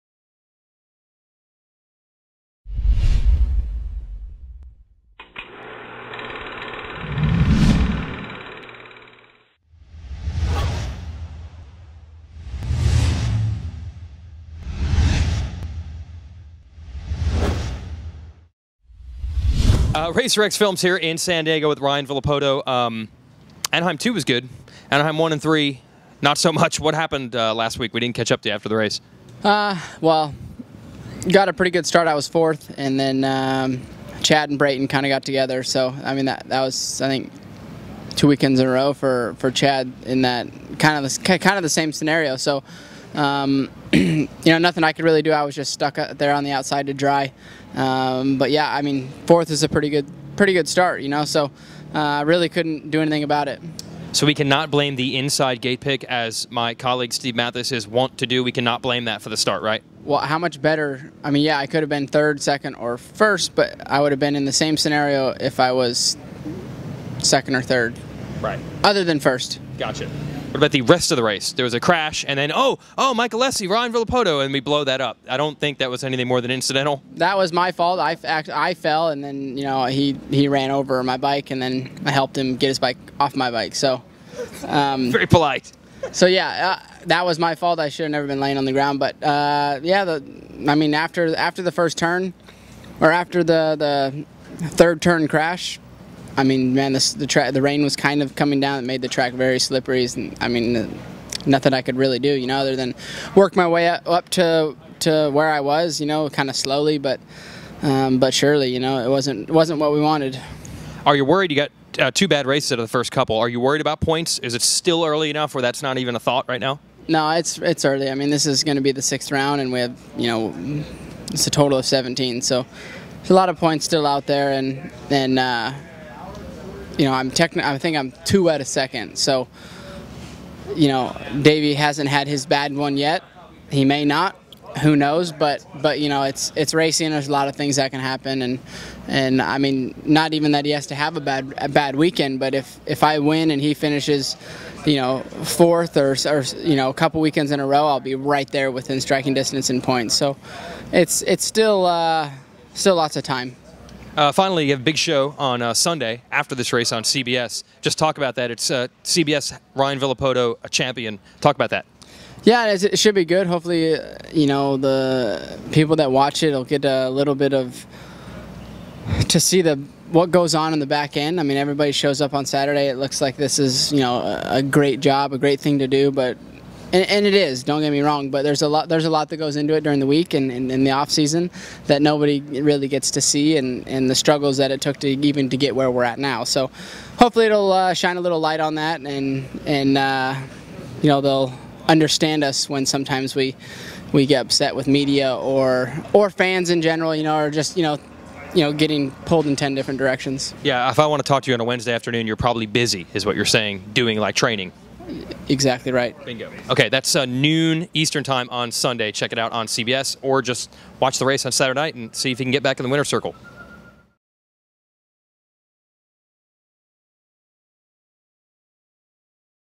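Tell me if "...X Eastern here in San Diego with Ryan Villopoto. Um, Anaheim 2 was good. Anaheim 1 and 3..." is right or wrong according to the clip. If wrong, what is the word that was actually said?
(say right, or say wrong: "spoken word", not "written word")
wrong: "Films", not "Eastern".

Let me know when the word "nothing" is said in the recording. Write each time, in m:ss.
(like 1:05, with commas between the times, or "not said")
0:44, 1:41.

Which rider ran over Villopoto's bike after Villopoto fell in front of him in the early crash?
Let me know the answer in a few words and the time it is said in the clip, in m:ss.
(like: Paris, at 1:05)
Michael Lessie, at 1:13.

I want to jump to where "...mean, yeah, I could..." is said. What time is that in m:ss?
1:01.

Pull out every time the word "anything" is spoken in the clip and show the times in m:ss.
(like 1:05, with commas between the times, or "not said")
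0:53, 1:16.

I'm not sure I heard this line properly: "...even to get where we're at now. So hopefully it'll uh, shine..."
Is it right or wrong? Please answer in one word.
right.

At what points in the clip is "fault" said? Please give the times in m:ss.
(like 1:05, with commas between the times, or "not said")
1:17, 1:27.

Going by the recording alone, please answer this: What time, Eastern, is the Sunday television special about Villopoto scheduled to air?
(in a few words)
Noon.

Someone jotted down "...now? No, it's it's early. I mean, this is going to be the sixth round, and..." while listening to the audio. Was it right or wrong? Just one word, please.
right.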